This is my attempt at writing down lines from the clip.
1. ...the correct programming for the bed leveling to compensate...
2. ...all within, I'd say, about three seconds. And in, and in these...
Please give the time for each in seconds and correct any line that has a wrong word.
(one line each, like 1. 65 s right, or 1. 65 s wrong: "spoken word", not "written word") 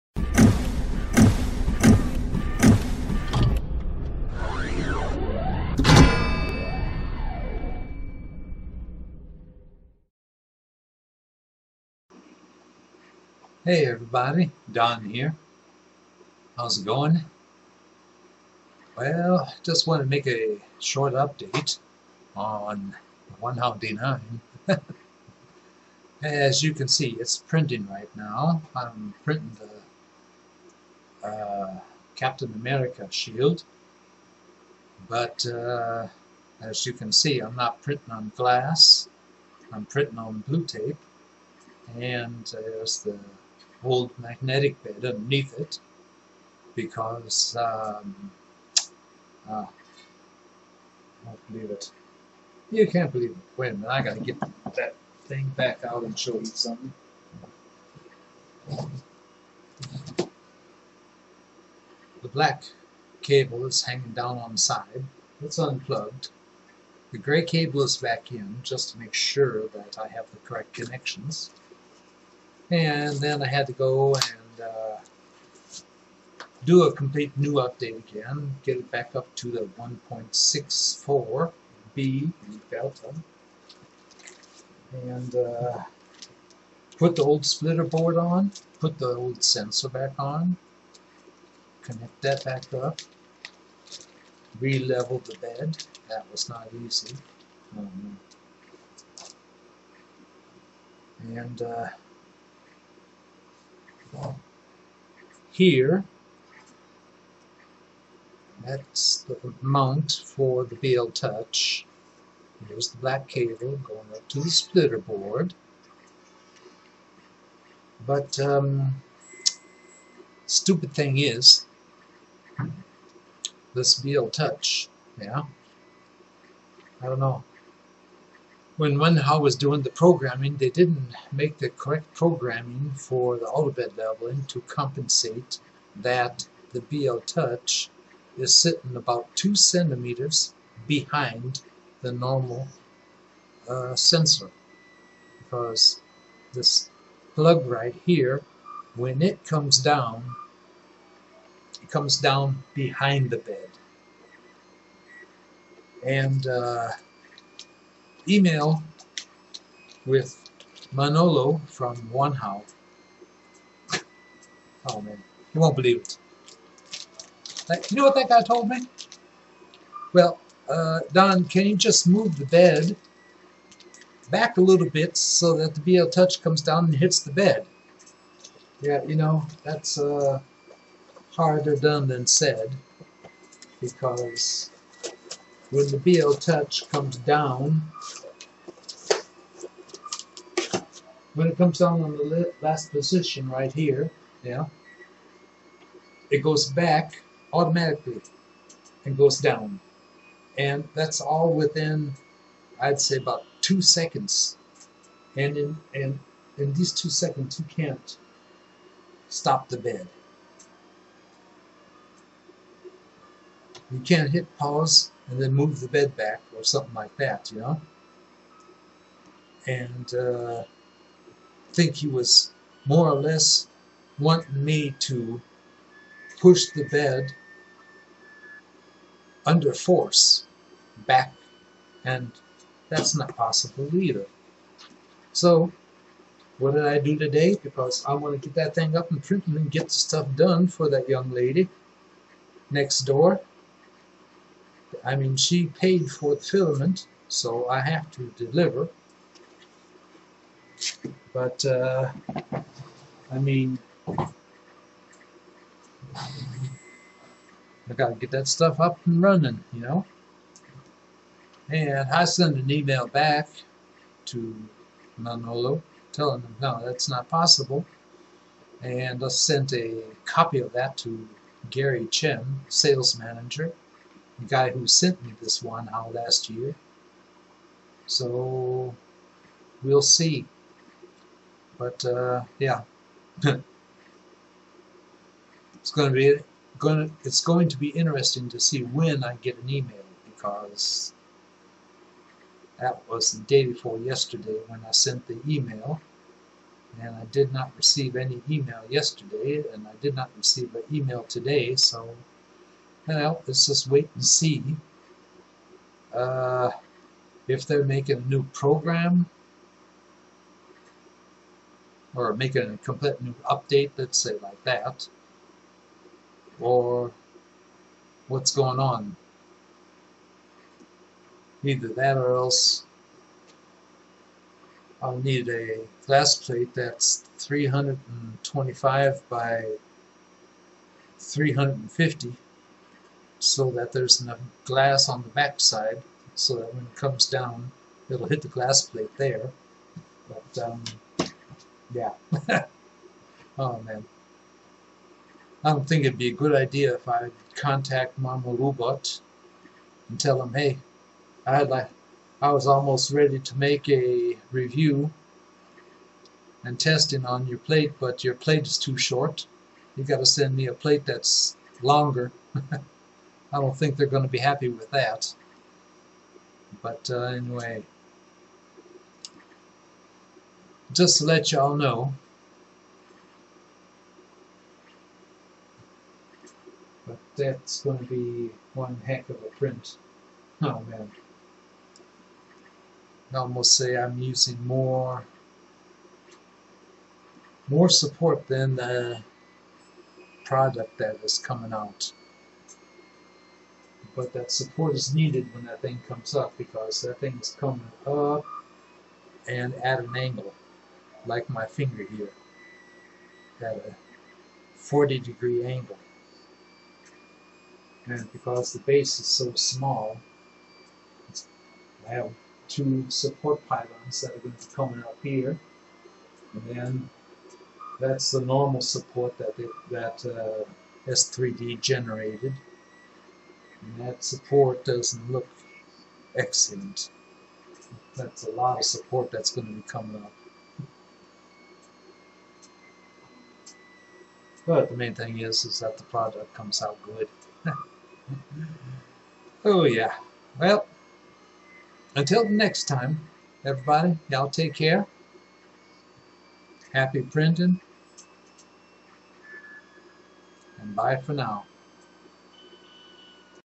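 1. 131 s right
2. 201 s wrong: "two", not "three".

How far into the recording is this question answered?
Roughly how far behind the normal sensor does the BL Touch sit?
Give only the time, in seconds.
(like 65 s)
139 s.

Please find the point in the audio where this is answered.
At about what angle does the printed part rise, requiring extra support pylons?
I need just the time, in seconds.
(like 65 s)
404 s.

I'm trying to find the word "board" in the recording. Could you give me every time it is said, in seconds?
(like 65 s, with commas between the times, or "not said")
87 s, 114 s.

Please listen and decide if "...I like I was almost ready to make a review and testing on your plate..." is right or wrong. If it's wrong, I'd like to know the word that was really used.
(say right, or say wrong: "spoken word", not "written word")
right.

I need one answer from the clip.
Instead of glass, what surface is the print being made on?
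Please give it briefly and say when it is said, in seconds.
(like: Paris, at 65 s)
blue tape, at 40 s.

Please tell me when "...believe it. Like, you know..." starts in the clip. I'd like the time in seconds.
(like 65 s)
165 s.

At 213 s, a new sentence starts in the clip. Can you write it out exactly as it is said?
You can't hit pause and then move the bed back or something like that, you know.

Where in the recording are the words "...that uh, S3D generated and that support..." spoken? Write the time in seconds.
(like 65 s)
419 s.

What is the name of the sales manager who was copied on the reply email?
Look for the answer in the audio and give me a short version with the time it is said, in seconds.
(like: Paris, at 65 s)
Gary Chen, at 271 s.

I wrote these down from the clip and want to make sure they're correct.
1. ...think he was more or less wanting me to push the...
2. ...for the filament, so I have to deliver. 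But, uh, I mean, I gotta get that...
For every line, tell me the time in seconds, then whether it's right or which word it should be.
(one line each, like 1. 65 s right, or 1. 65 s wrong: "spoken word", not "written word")
1. 221 s right
2. 246 s right.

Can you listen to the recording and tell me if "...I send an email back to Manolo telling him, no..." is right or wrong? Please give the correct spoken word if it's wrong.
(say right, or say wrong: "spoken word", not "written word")
right.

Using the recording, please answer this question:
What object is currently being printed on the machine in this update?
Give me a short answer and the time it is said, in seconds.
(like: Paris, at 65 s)
Captain America shield, at 32 s.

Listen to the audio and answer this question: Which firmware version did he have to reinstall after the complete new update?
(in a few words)
1.64 B.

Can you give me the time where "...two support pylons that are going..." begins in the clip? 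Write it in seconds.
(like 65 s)
412 s.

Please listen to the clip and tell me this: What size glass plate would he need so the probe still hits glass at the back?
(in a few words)
325 by 350.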